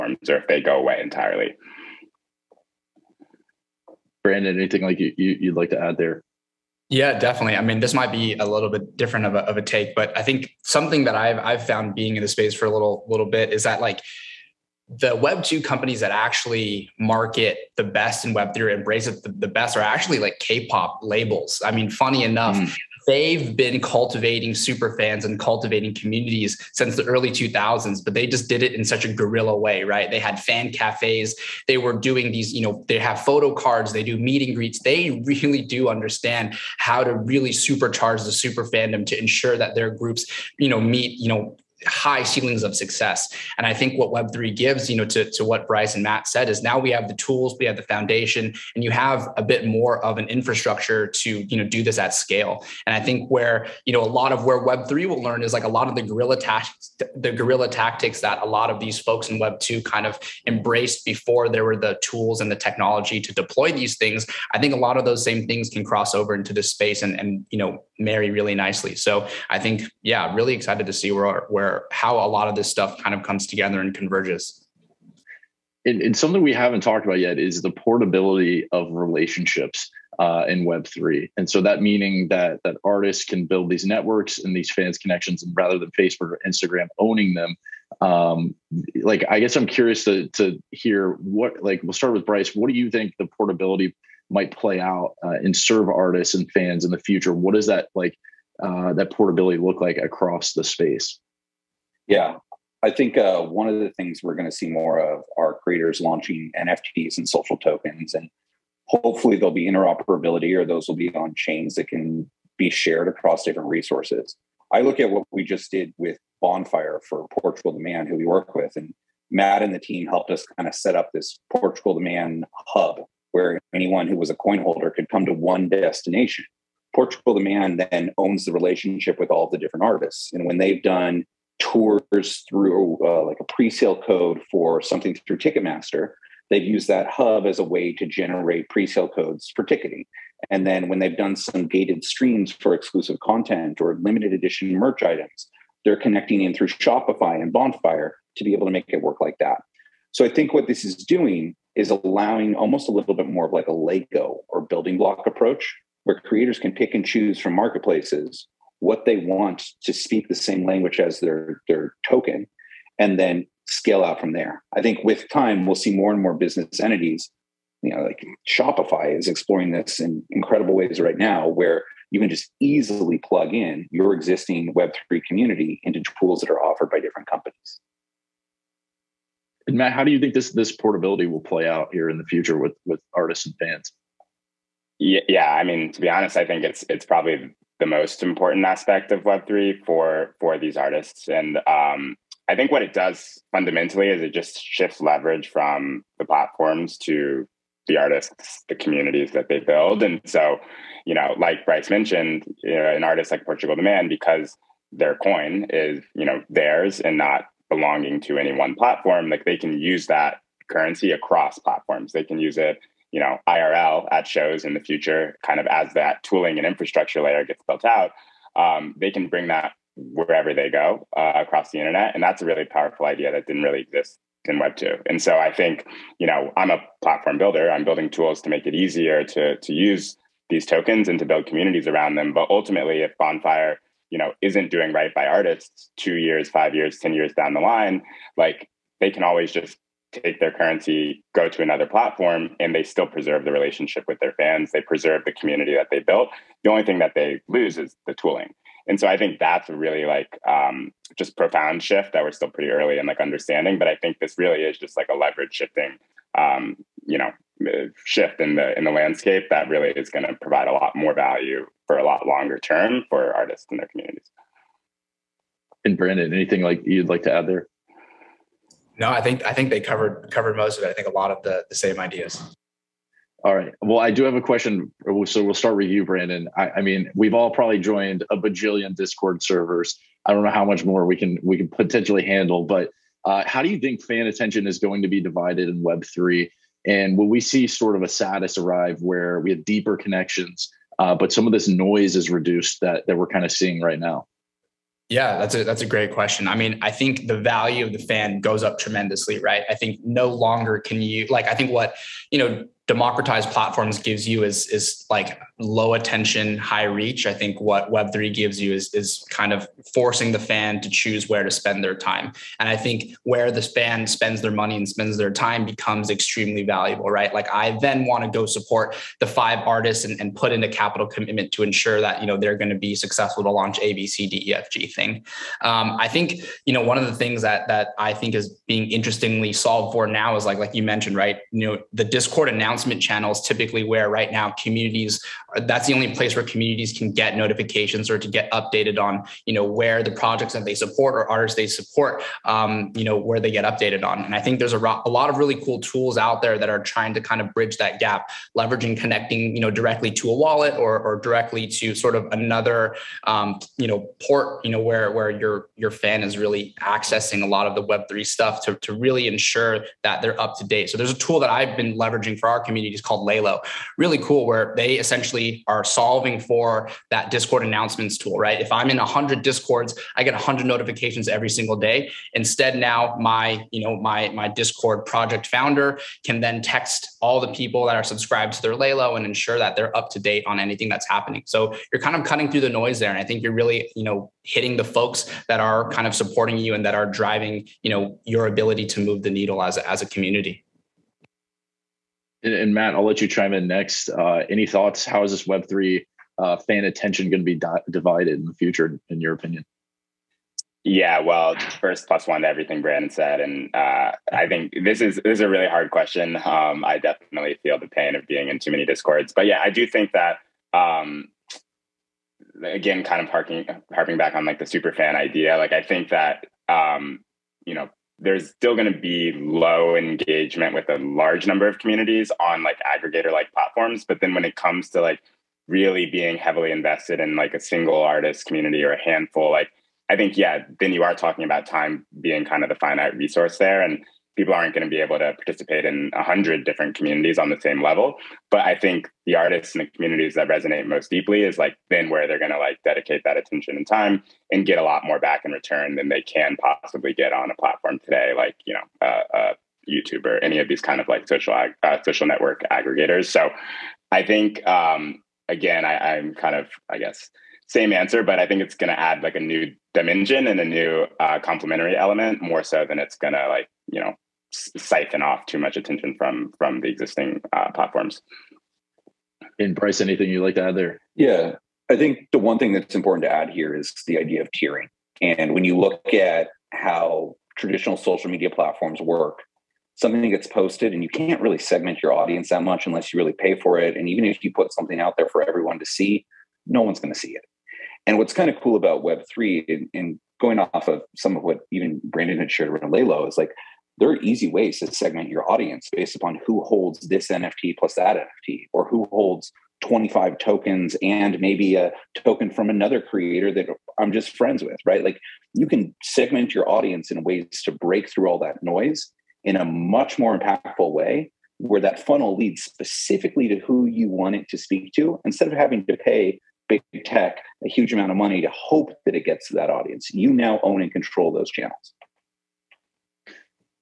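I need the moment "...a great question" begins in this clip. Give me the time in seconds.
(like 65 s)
295 s.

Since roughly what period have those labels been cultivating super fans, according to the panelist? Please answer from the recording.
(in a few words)
Early 2000s.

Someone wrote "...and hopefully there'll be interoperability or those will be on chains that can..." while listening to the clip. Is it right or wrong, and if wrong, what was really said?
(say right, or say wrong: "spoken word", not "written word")
right.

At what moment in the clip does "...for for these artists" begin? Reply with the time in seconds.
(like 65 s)
189 s.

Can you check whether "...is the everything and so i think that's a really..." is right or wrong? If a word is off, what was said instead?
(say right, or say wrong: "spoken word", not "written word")
wrong: "tooling", not "everything".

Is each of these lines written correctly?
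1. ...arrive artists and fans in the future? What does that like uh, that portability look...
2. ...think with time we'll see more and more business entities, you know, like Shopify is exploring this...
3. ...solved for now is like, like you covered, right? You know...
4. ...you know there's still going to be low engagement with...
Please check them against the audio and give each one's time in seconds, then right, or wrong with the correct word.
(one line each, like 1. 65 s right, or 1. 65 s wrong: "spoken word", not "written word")
1. 95 s wrong: "serve", not "arrive"
2. 164 s right
3. 329 s wrong: "mentioned", not "covered"
4. 417 s right.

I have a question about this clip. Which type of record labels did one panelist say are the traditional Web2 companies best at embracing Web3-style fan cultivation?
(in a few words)
K-pop labels.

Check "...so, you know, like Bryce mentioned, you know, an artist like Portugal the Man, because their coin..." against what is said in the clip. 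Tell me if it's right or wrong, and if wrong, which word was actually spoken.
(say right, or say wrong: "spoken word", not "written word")
right.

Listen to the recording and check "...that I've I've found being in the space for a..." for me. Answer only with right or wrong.
right.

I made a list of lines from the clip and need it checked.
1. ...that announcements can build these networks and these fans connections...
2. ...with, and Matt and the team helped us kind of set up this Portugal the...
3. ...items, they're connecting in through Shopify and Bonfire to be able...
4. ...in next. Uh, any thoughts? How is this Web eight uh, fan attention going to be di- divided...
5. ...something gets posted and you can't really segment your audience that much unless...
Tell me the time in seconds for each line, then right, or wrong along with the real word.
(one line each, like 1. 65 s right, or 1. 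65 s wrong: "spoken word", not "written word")
1. 82 s wrong: "artists", not "announcements"
2. 118 s right
3. 145 s right
4. 393 s wrong: "three", not "eight"
5. 479 s right.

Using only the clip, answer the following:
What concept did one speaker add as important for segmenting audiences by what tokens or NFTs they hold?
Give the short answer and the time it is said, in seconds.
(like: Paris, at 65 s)
Tiering, at 474 s.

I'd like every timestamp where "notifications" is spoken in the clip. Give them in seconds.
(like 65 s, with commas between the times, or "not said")
337 s, 370 s.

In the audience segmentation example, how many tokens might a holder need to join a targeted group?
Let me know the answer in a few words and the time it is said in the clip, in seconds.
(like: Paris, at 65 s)
25, at 499 s.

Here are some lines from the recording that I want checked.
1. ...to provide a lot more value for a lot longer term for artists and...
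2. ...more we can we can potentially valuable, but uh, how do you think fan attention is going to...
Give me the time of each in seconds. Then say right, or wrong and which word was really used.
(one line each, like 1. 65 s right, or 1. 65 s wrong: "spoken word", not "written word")
1. 260 s right
2. 280 s wrong: "handle", not "valuable".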